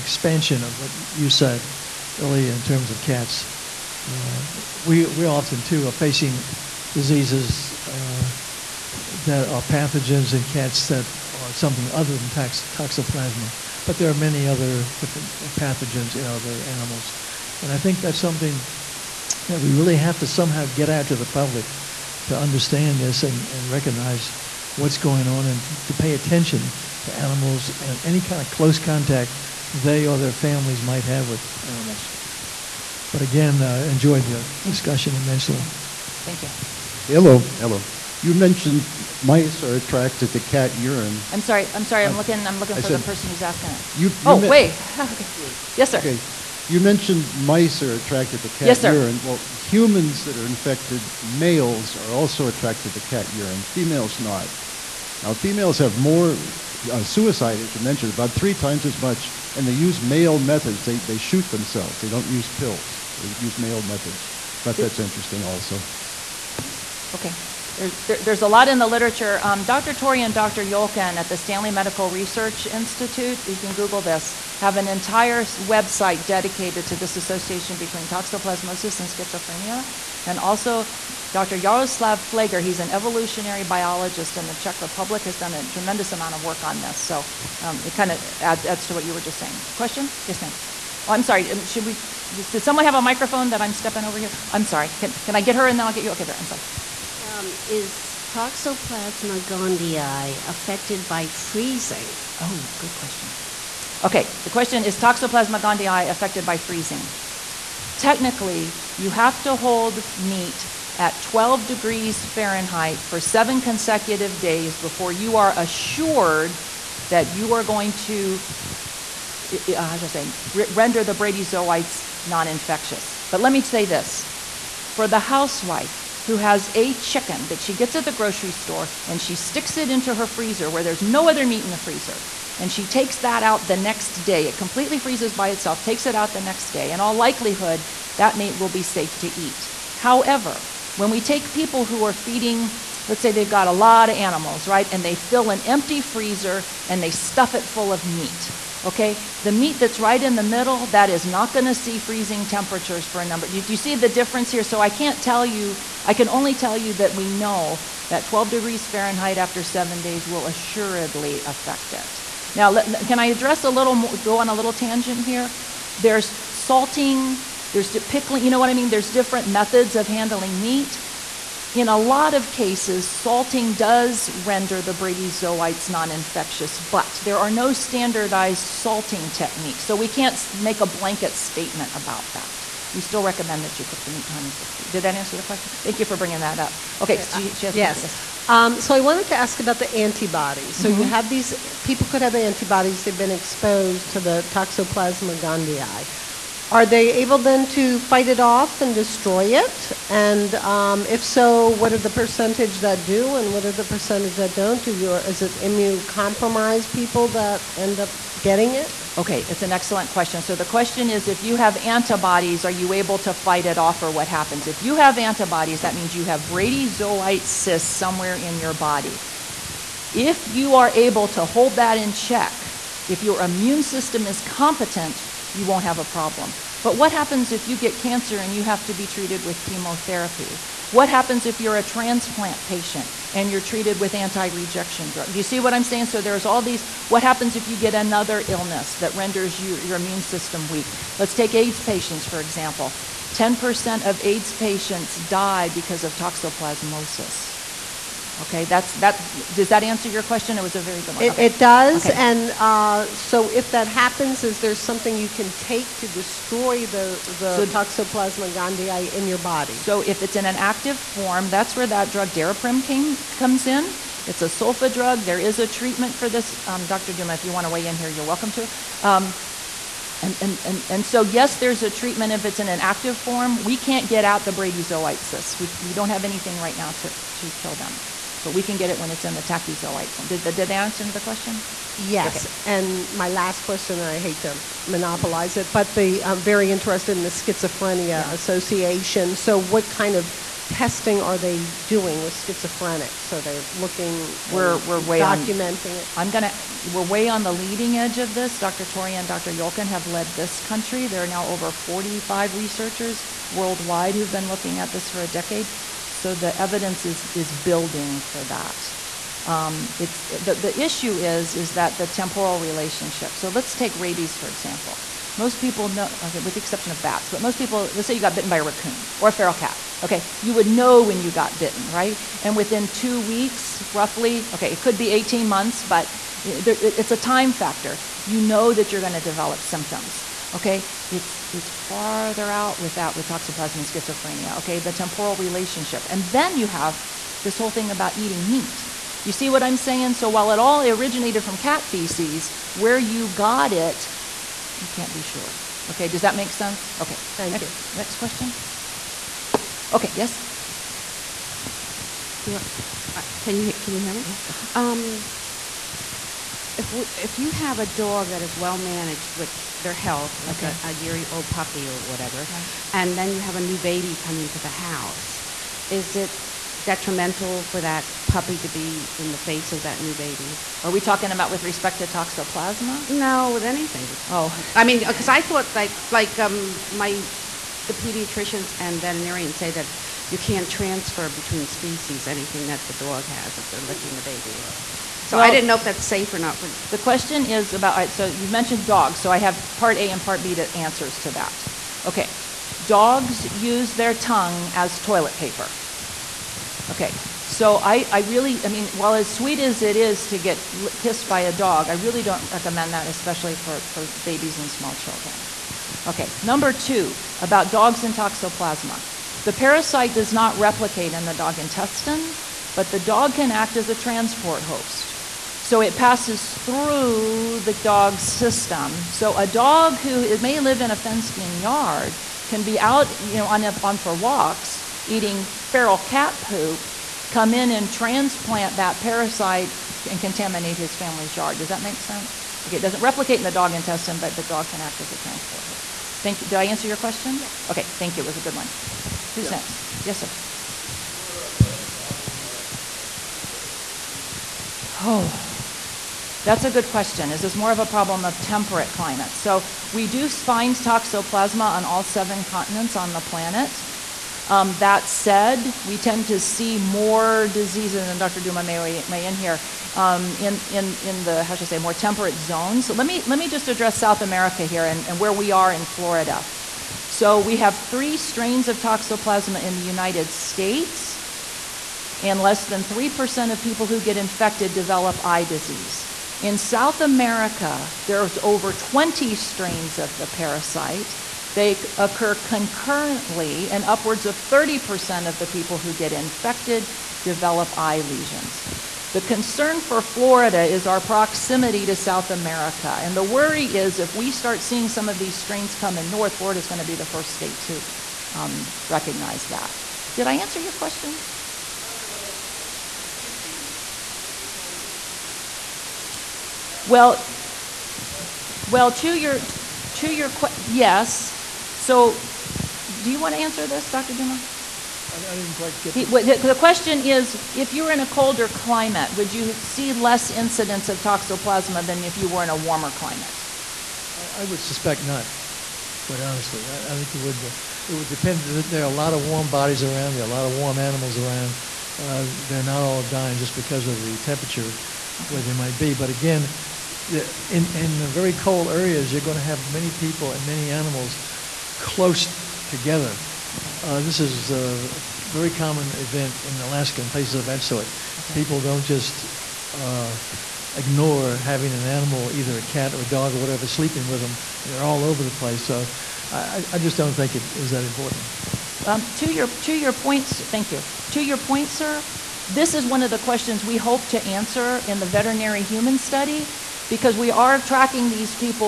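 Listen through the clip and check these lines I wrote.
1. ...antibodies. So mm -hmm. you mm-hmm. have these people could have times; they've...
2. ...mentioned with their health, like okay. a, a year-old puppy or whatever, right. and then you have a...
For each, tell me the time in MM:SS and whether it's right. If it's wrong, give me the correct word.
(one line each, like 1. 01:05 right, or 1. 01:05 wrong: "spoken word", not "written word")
1. 03:10 wrong: "antibodies", not "times"
2. 05:58 wrong: "managed", not "mentioned".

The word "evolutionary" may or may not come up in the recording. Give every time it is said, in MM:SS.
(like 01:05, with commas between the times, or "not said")
01:22.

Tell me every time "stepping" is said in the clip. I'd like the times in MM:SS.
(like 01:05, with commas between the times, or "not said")
01:33.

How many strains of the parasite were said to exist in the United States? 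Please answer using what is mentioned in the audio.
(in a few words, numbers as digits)
3.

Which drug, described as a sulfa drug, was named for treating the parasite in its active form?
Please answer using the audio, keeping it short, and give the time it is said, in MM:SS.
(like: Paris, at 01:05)
Daraprim, at 04:22.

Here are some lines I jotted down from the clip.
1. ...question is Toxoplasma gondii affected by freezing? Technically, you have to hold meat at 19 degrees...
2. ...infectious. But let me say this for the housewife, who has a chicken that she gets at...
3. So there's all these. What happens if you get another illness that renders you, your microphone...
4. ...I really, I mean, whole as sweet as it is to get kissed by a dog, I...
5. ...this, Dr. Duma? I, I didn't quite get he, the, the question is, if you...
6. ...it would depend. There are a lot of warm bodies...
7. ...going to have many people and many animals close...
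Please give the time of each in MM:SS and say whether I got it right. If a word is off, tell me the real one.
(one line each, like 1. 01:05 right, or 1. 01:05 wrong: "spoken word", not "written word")
1. 01:44 wrong: "12", not "19"
2. 02:02 right
3. 03:56 wrong: "immune", not "microphone"
4. 06:38 wrong: "while", not "whole"
5. 08:33 right
6. 08:47 right
7. 08:59 right.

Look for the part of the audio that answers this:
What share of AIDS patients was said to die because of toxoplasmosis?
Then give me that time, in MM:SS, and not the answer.
04:03.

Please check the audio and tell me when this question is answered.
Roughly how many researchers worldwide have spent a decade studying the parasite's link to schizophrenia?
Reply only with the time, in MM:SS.
05:01.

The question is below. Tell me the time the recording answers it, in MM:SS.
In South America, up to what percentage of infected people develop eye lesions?
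08:04.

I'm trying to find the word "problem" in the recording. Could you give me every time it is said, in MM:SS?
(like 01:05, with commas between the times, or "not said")
03:46, 07:21, 07:27.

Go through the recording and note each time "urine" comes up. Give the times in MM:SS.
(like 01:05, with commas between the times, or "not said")
00:40, 00:48, 00:53.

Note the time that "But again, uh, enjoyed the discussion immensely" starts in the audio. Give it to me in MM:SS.
00:33.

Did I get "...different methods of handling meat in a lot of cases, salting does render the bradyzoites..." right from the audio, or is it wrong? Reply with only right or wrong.
right.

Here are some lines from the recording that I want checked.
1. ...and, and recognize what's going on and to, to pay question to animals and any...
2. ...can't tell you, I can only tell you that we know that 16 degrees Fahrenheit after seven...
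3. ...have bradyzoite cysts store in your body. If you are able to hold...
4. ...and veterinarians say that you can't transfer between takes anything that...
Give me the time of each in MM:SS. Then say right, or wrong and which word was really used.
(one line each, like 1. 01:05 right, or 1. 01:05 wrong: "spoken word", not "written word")
1. 00:23 wrong: "attention", not "question"
2. 02:34 wrong: "12", not "16"
3. 03:36 wrong: "somewhere", not "store"
4. 06:18 wrong: "species", not "takes".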